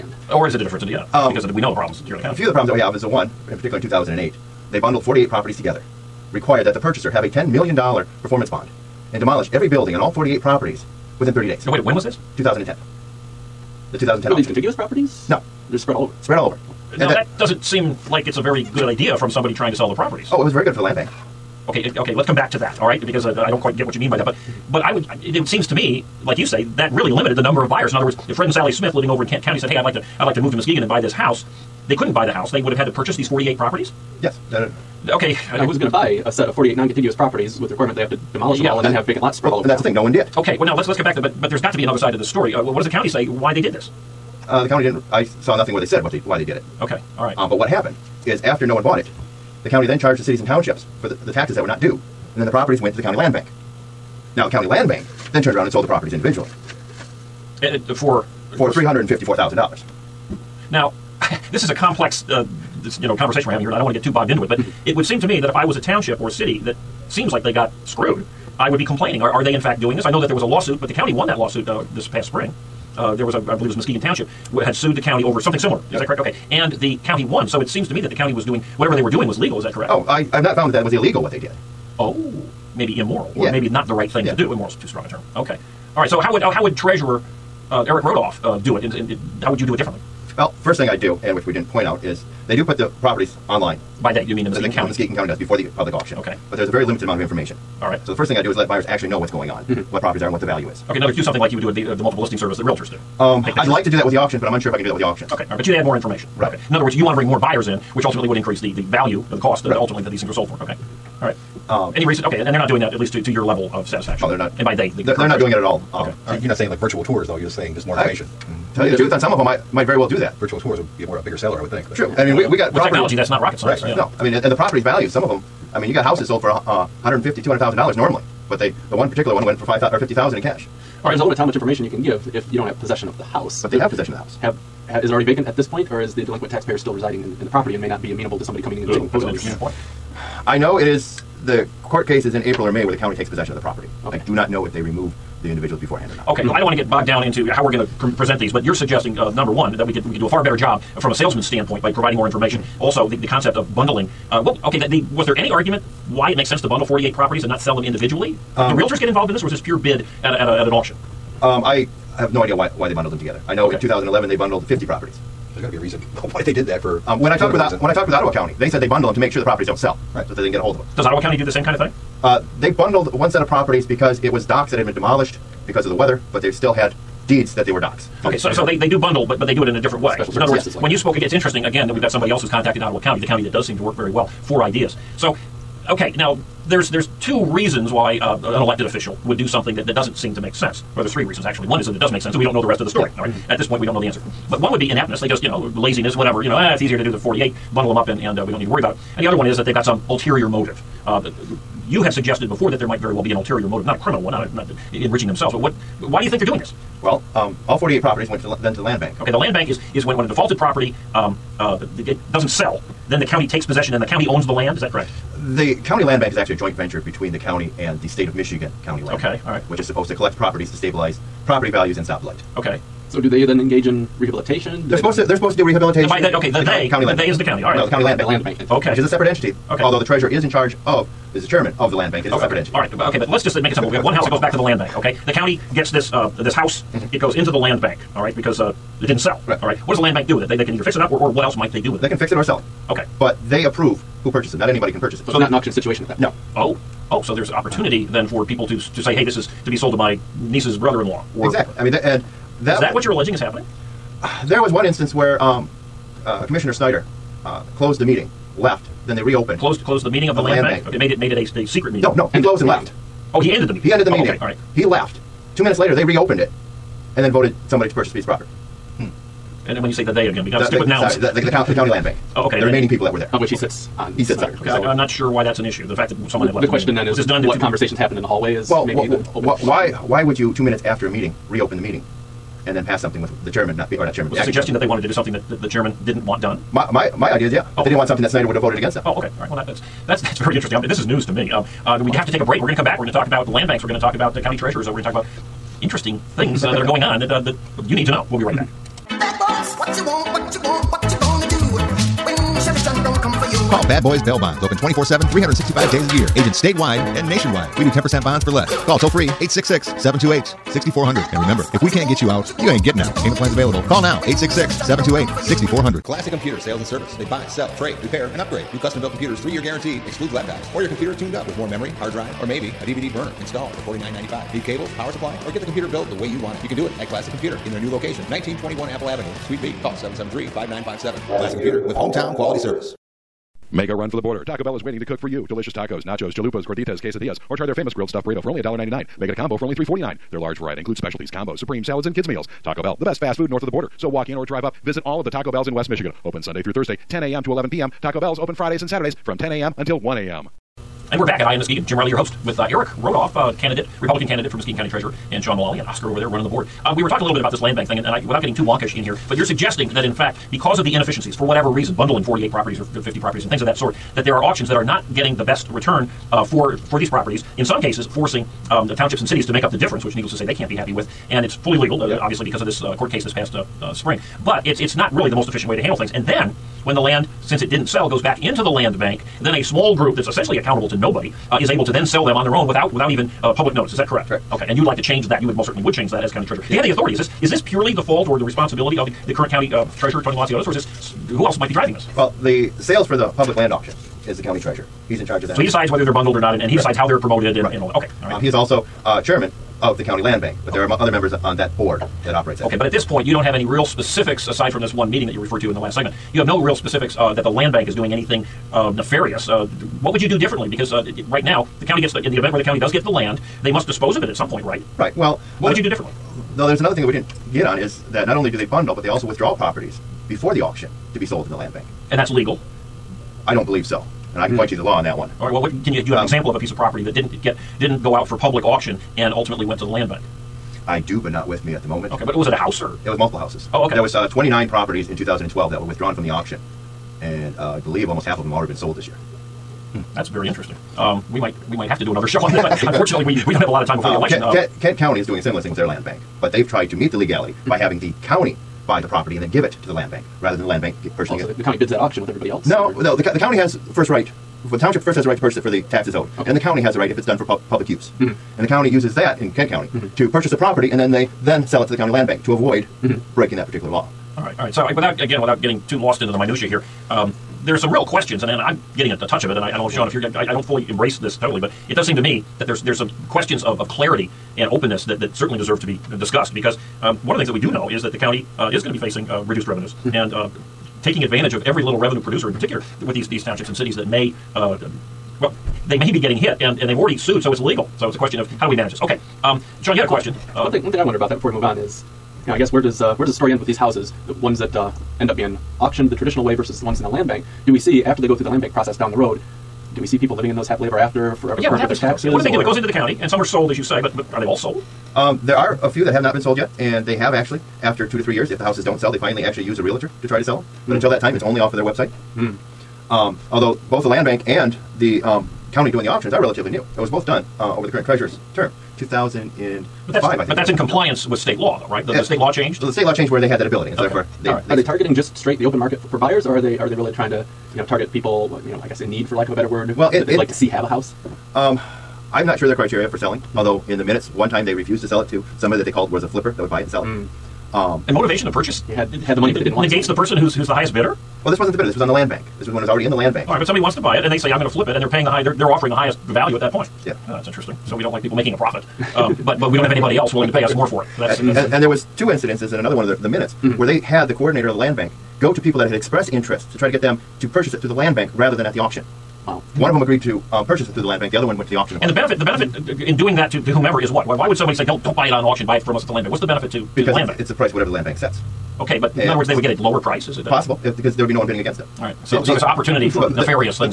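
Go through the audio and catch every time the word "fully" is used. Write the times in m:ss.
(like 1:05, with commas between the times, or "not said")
6:11, 7:50.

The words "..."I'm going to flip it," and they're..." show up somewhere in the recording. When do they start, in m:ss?
9:04.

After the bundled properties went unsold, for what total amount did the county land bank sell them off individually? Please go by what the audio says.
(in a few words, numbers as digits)
$354,000.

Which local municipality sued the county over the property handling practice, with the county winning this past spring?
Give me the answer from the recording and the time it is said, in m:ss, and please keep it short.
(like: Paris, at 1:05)
Muskegon Township, at 1:13.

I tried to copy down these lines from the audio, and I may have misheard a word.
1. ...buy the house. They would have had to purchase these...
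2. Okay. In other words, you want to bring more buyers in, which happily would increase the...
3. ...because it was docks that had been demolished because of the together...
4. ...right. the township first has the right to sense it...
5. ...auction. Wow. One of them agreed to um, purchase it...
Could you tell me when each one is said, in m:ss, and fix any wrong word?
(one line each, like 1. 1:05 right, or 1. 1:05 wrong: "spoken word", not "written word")
1. 0:32 right
2. 1:46 wrong: "ultimately", not "happily"
3. 2:53 wrong: "weather", not "together"
4. 7:34 wrong: "purchase", not "sense"
5. 9:18 right.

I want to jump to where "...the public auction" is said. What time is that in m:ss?
1:35.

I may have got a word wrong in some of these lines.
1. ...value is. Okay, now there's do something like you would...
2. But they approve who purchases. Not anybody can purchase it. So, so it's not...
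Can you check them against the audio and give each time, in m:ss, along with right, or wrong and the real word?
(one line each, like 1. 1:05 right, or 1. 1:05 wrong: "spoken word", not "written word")
1. 1:40 right
2. 4:03 right.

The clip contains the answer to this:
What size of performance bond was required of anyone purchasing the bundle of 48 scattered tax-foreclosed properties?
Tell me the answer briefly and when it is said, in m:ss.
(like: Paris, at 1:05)
$10 million, at 0:07.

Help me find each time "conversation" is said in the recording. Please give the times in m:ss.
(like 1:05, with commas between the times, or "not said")
1:03, 4:37.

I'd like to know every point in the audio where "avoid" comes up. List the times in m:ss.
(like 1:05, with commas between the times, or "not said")
7:42.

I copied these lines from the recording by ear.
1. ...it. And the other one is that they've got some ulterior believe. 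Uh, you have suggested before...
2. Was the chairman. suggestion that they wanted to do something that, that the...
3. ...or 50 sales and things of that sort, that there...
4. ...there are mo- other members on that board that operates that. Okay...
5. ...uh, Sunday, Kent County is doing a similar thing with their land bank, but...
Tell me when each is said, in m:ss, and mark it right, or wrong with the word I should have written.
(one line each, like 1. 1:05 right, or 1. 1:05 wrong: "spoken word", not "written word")
1. 3:18 wrong: "motive", not "believe"
2. 4:44 right
3. 6:02 wrong: "properties", not "sales"
4. 6:40 right
5. 7:24 wrong: "Kent", not "Sunday".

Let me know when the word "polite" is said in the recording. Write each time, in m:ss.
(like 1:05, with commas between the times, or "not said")
not said.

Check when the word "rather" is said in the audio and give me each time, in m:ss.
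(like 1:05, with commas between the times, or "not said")
7:30, 9:18.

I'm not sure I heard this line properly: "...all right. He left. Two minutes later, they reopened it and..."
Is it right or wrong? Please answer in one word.
right.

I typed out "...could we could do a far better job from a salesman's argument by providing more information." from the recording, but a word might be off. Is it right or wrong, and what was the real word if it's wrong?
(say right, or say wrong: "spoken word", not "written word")
wrong: "standpoint", not "argument".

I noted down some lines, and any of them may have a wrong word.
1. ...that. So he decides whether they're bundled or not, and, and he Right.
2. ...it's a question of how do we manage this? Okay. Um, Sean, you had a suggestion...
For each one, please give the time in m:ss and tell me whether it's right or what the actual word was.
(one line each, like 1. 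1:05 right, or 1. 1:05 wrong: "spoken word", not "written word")
1. 6:35 right
2. 8:08 wrong: "question", not "suggestion".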